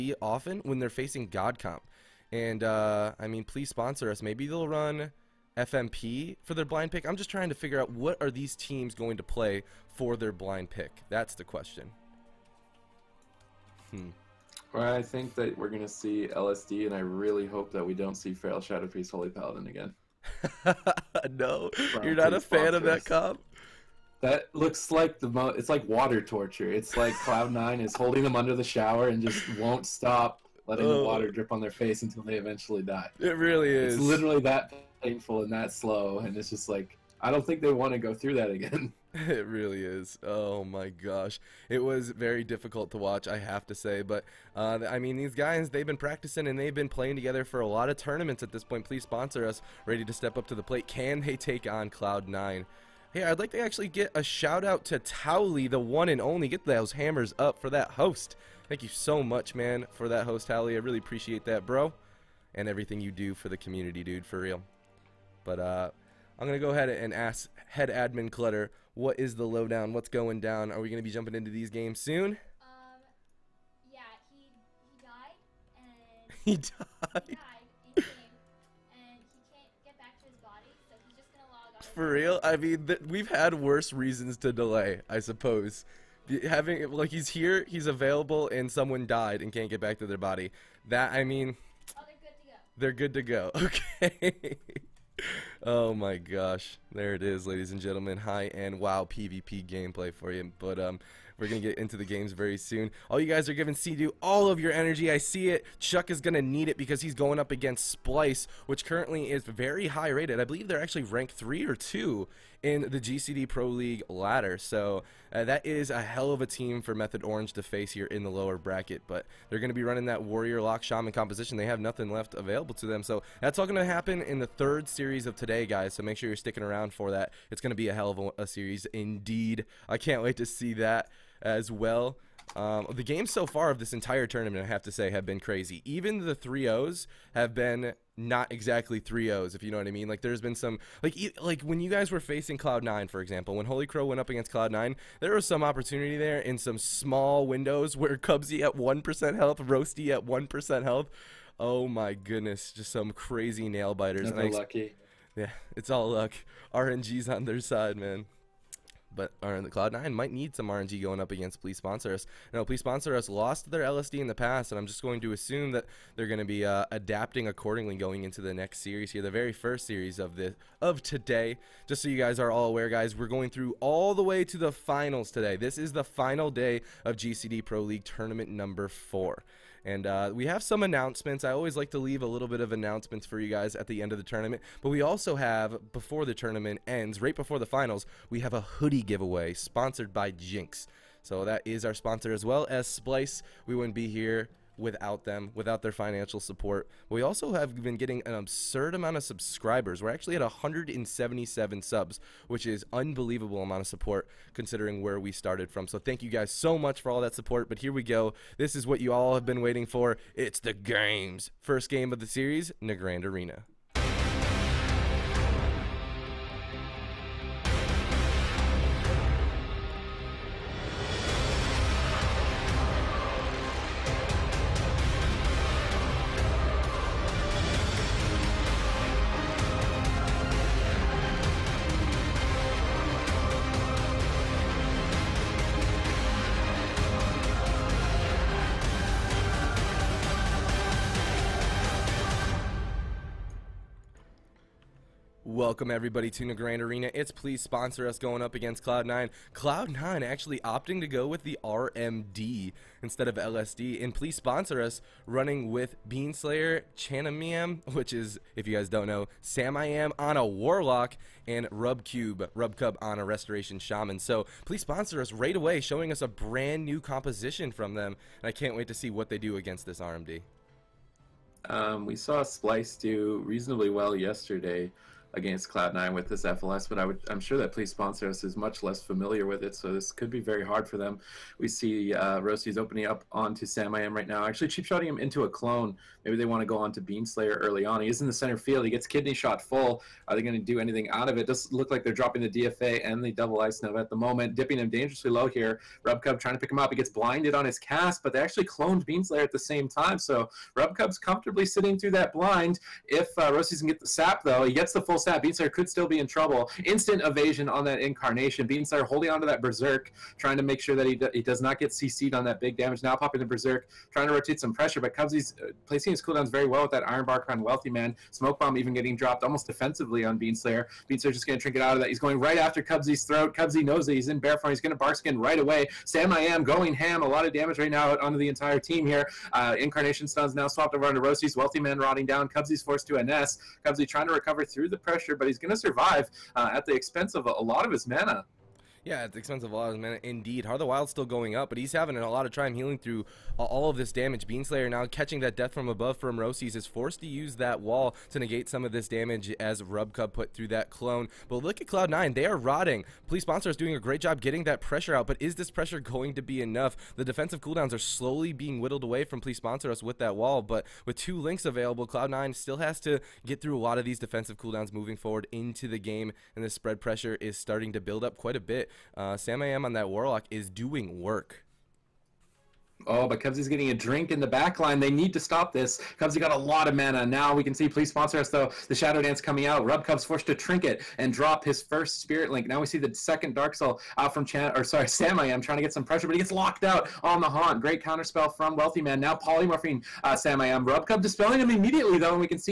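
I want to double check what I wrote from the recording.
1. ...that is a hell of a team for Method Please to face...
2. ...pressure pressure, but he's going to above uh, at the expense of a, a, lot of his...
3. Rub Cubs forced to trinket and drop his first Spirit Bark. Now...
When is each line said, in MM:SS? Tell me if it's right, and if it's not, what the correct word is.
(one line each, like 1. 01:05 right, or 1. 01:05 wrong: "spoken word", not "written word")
1. 01:55 wrong: "Orange", not "Please"
2. 05:34 wrong: "survive", not "above"
3. 06:19 wrong: "Link", not "Bark".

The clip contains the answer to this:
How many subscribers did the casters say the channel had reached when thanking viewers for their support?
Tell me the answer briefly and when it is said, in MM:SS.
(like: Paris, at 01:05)
177, at 03:20.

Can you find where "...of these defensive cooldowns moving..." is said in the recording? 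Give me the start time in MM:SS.
06:03.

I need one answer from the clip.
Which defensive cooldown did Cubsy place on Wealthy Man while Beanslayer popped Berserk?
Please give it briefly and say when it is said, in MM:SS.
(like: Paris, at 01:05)
Iron Bark, at 05:17.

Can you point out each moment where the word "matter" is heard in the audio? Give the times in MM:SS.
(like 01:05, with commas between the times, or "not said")
not said.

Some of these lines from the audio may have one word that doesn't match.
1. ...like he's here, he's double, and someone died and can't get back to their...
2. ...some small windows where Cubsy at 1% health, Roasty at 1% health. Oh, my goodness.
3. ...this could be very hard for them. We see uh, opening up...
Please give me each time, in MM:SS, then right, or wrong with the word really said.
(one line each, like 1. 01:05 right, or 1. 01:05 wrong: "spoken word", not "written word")
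1. 01:26 wrong: "available", not "double"
2. 02:26 right
3. 04:39 right.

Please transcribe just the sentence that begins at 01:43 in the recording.
All you guys are giving CDU all of your energy.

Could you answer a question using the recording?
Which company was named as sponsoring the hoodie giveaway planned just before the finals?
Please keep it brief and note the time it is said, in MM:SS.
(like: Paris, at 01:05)
Jinx, at 03:10.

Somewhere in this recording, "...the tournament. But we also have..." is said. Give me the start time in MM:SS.
03:04.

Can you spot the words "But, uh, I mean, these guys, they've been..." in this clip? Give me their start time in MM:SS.
00:44.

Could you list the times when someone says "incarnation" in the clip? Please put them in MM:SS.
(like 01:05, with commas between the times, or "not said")
05:08, 05:29.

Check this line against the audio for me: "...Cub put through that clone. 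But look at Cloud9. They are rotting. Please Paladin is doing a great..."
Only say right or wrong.
wrong.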